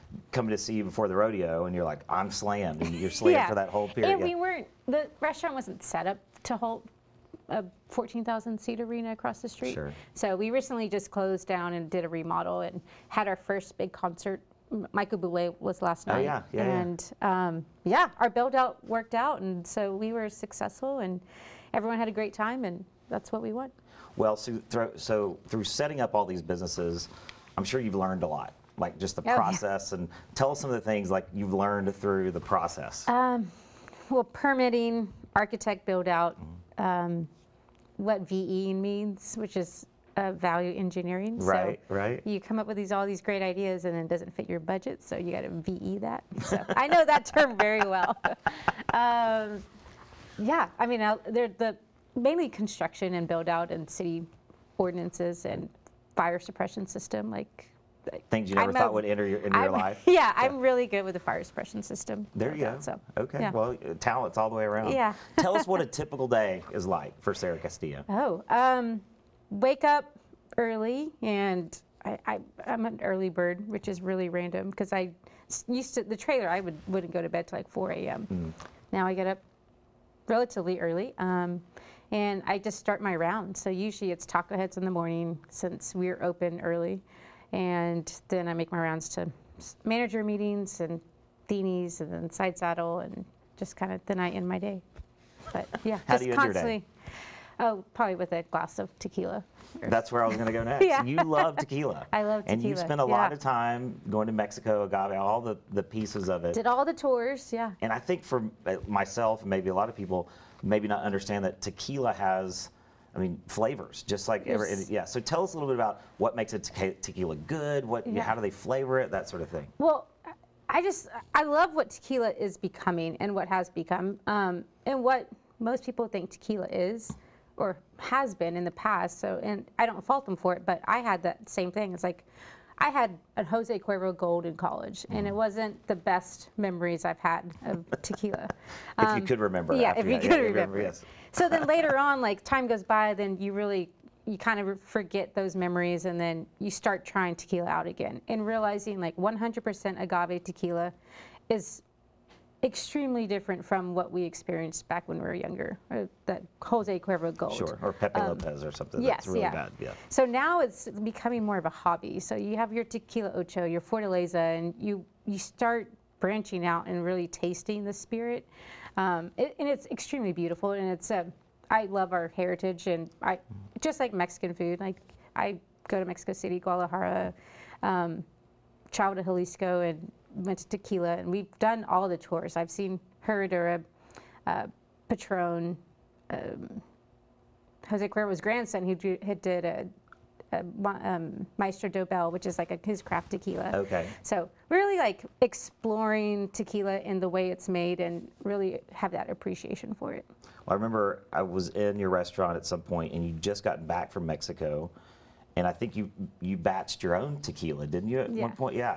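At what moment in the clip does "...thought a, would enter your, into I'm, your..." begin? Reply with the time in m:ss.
0:58.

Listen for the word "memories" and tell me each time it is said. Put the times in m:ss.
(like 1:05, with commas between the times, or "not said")
2:16, 2:25.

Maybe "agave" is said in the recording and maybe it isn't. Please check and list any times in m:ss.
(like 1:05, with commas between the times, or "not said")
1:44, 2:30.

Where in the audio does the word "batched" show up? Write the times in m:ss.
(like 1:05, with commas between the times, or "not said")
3:26.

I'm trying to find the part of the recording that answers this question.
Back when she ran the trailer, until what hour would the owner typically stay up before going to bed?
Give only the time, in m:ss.
1:17.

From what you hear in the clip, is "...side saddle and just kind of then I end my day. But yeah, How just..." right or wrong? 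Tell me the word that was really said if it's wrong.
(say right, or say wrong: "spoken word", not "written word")
right.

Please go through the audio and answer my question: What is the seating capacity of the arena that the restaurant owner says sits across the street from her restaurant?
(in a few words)
14,000.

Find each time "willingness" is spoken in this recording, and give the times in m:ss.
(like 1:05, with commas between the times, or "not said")
not said.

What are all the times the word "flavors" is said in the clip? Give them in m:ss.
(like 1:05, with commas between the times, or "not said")
1:53, 1:58.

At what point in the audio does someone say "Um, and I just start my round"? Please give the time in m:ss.
1:21.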